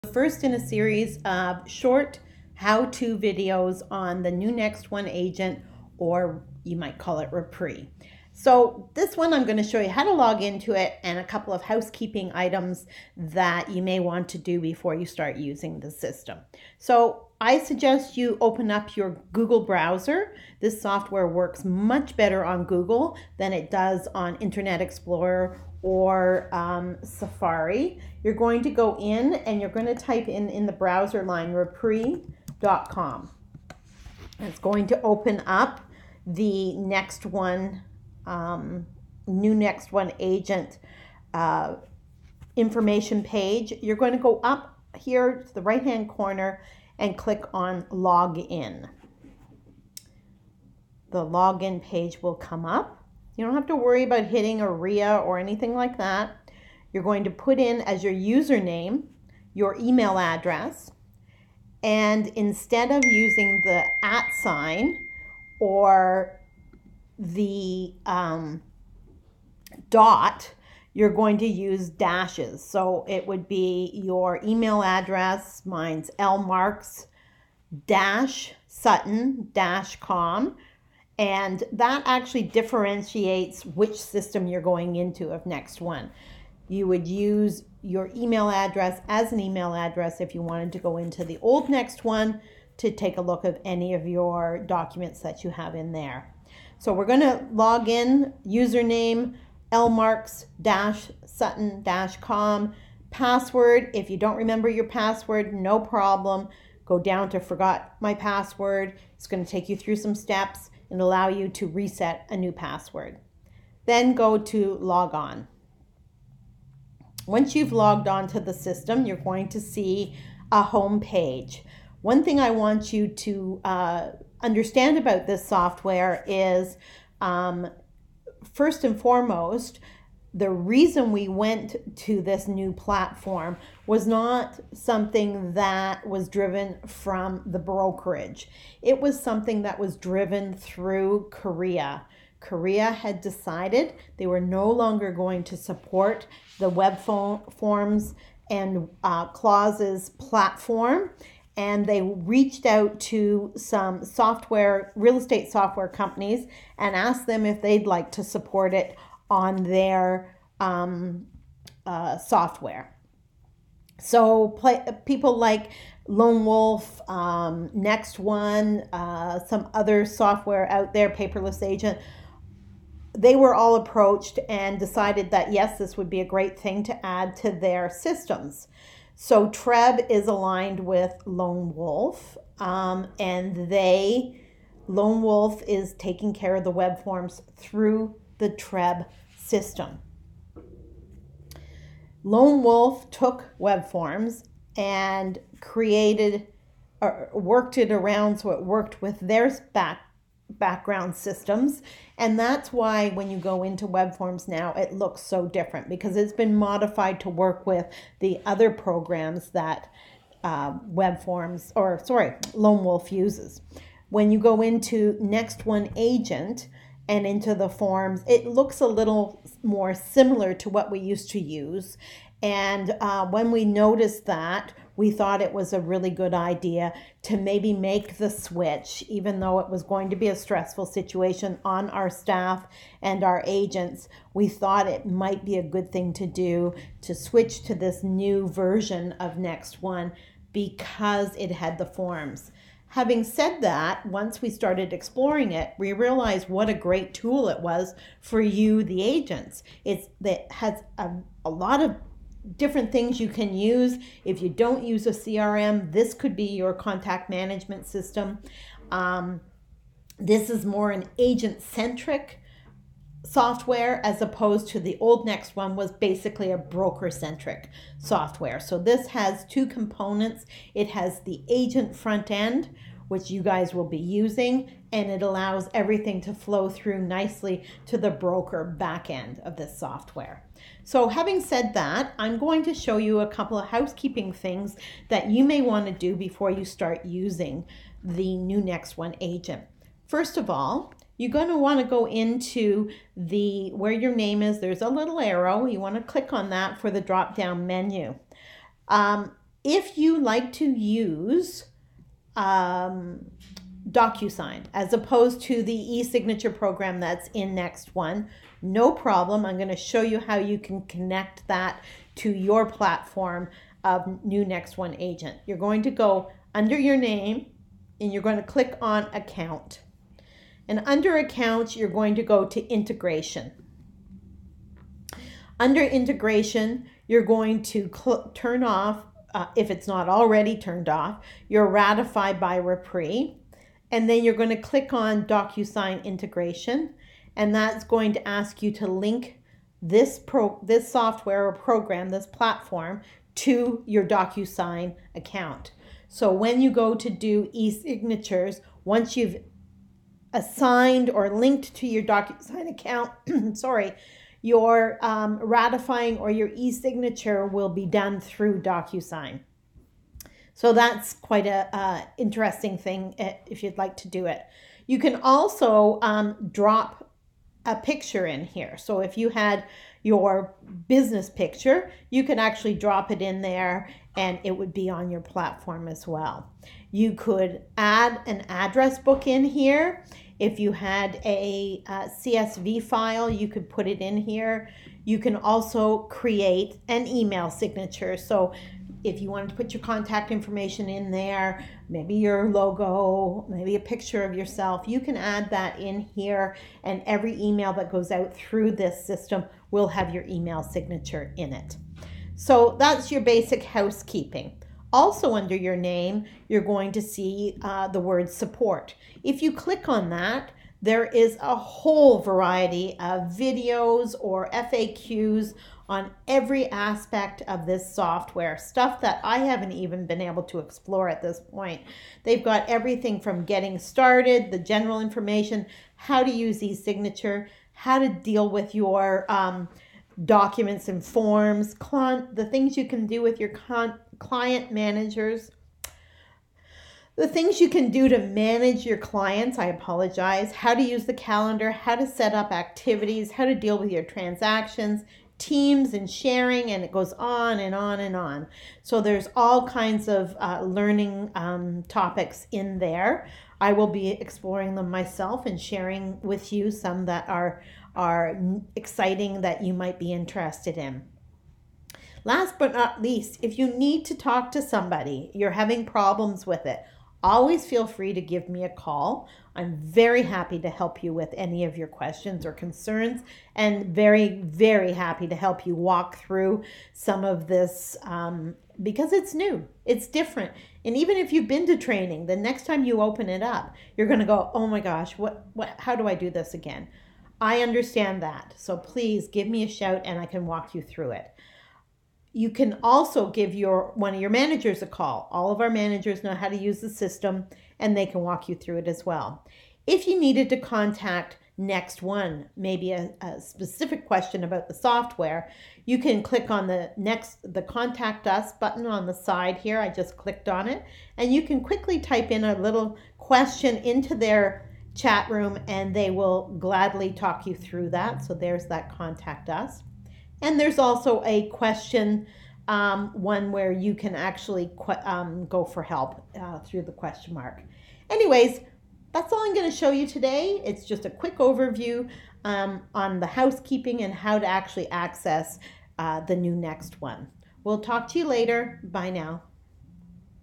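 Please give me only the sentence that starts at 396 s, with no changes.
And every email that goes out through this system will have your email signature in it.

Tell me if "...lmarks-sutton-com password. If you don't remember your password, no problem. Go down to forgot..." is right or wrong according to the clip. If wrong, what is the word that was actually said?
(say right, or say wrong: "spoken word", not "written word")
right.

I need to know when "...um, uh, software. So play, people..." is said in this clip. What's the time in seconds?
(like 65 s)
160 s.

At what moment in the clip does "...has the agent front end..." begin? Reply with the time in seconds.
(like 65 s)
270 s.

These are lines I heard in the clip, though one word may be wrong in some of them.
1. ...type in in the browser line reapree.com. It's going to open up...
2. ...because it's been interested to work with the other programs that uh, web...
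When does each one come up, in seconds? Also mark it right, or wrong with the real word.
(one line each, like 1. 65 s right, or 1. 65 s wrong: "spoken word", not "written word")
1. 29 s right
2. 205 s wrong: "modified", not "interested".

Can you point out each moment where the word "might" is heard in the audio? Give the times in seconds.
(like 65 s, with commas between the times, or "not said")
6 s, 235 s, 459 s.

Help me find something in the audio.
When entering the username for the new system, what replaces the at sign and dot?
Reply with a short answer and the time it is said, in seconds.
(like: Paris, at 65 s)
dashes, at 71 s.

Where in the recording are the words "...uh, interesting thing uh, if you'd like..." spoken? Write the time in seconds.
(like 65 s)
361 s.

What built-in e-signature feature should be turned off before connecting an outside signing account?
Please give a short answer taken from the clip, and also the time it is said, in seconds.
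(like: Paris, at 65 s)
Ratify by REPRI, at 331 s.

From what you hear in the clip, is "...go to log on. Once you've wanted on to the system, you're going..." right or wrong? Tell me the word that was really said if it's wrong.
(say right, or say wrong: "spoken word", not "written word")
wrong: "logged", not "wanted".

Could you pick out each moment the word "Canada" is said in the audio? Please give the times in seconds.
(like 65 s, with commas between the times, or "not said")
not said.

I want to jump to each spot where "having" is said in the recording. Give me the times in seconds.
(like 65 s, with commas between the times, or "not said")
242 s, 281 s, 465 s.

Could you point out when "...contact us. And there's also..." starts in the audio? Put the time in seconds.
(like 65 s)
518 s.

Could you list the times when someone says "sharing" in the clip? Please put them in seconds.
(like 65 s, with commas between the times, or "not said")
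446 s, 455 s.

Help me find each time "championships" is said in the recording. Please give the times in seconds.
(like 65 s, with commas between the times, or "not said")
not said.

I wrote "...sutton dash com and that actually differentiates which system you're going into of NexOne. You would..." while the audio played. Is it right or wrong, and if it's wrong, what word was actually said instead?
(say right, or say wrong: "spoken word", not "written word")
right.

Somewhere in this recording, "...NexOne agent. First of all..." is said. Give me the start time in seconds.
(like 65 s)
288 s.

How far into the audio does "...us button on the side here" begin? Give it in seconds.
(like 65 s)
508 s.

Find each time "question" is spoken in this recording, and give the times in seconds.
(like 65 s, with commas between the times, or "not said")
471 s, 504 s, 513 s, 521 s, 526 s.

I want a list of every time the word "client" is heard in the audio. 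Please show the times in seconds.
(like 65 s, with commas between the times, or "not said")
434 s, 438 s.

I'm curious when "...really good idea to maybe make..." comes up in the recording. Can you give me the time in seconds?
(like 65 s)
225 s.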